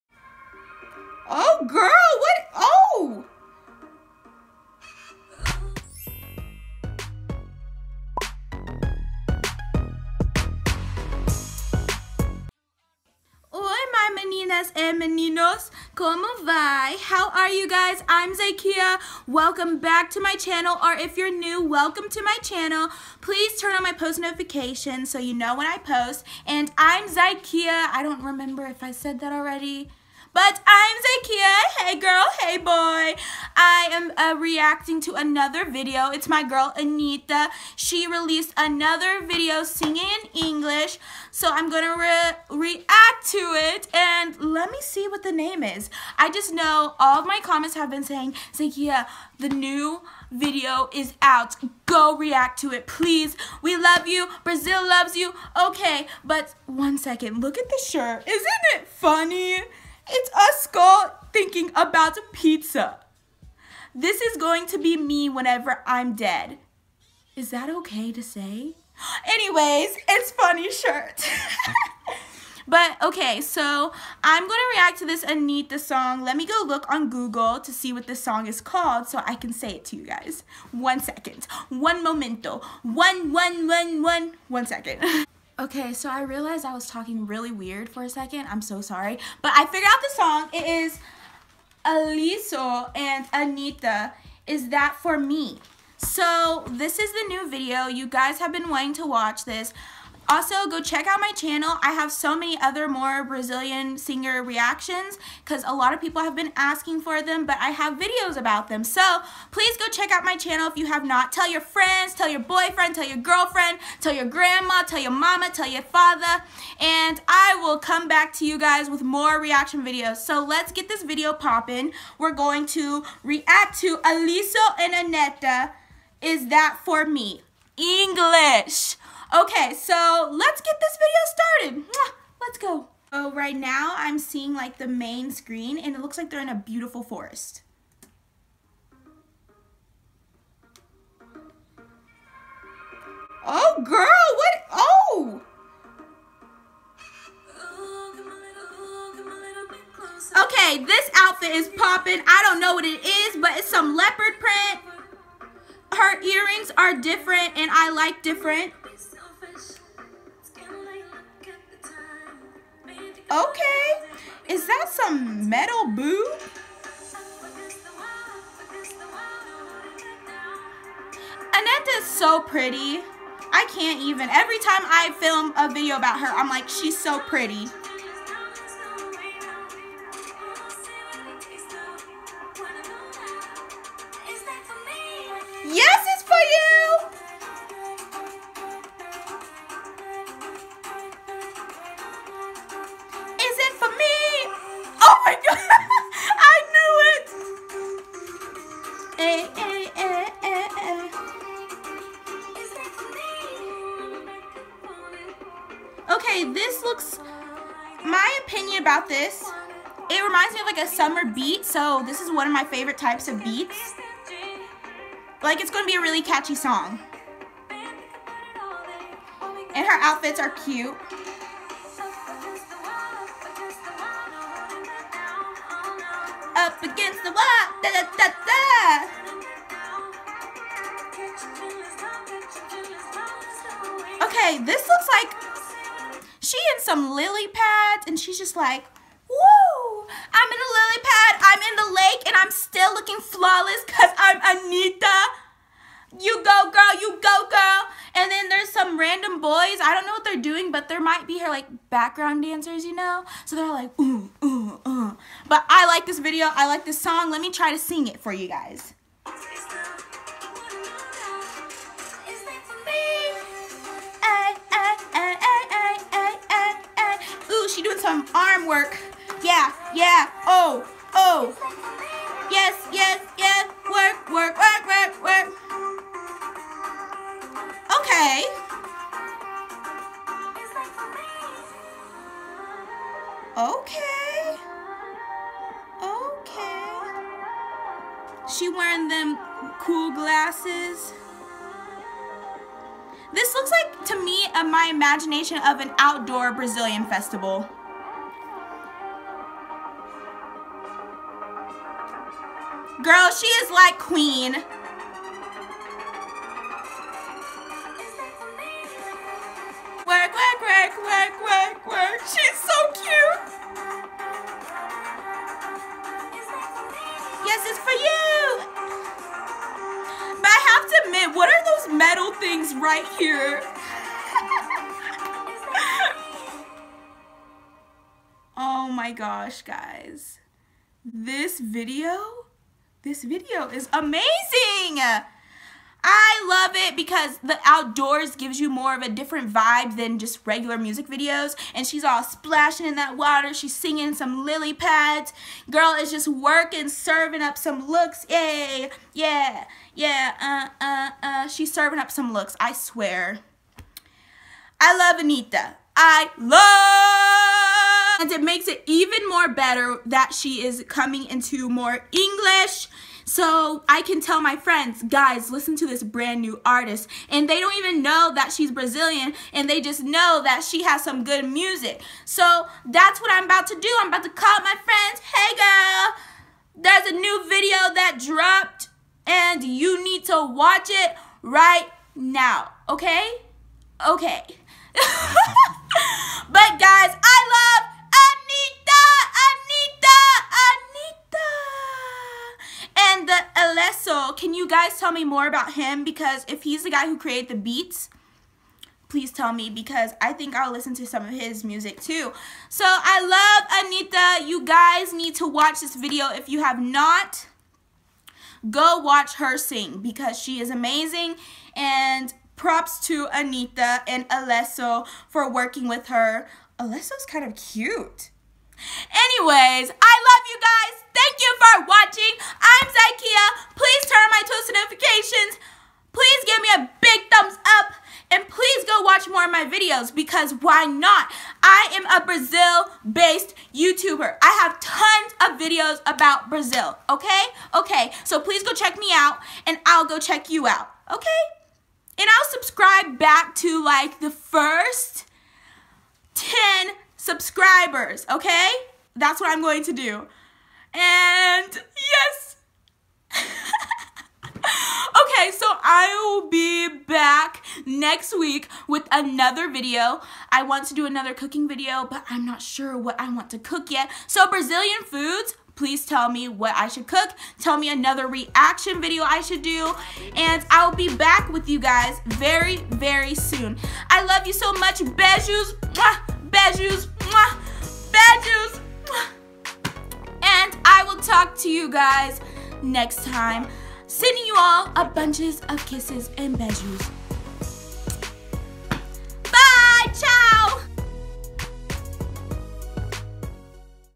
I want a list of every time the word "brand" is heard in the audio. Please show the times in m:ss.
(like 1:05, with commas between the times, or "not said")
6:06.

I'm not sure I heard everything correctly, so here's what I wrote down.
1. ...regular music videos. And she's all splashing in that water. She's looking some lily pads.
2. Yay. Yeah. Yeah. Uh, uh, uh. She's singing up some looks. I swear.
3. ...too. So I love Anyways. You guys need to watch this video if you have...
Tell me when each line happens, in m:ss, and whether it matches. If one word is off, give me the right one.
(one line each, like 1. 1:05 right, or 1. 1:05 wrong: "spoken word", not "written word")
1. 5:40 wrong: "singing", not "looking"
2. 5:48 wrong: "serving", not "singing"
3. 6:42 wrong: "Anitta", not "Anyways".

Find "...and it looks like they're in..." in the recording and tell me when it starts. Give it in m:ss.
2:15.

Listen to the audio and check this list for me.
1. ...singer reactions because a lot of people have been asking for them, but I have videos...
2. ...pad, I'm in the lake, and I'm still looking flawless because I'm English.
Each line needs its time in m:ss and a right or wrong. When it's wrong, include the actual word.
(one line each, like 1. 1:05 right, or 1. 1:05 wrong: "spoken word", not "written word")
1. 1:43 right
2. 4:01 wrong: "Anitta", not "English".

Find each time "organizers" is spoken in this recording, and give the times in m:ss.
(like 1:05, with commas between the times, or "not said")
not said.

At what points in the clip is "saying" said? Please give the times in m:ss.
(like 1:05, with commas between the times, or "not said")
0:48.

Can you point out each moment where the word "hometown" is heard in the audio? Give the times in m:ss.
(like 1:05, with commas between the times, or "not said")
not said.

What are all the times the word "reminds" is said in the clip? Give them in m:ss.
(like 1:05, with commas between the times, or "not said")
3:30.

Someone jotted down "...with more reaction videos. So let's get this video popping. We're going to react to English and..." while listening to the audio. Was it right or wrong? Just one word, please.
wrong.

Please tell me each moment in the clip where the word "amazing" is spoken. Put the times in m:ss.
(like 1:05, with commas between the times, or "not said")
5:33, 6:50.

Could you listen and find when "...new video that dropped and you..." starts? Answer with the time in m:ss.
6:17.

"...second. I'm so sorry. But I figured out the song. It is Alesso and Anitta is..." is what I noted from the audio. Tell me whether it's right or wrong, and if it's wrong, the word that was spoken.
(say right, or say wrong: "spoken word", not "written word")
right.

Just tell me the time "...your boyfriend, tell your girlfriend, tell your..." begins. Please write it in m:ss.
1:52.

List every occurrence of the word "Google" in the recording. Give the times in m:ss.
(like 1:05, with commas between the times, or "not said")
1:17.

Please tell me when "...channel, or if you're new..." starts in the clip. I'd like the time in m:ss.
0:20.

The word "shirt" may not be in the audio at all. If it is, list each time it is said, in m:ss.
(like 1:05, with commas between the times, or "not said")
0:57, 1:10.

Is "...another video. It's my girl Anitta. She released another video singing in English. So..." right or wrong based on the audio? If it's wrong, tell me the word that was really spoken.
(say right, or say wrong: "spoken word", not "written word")
right.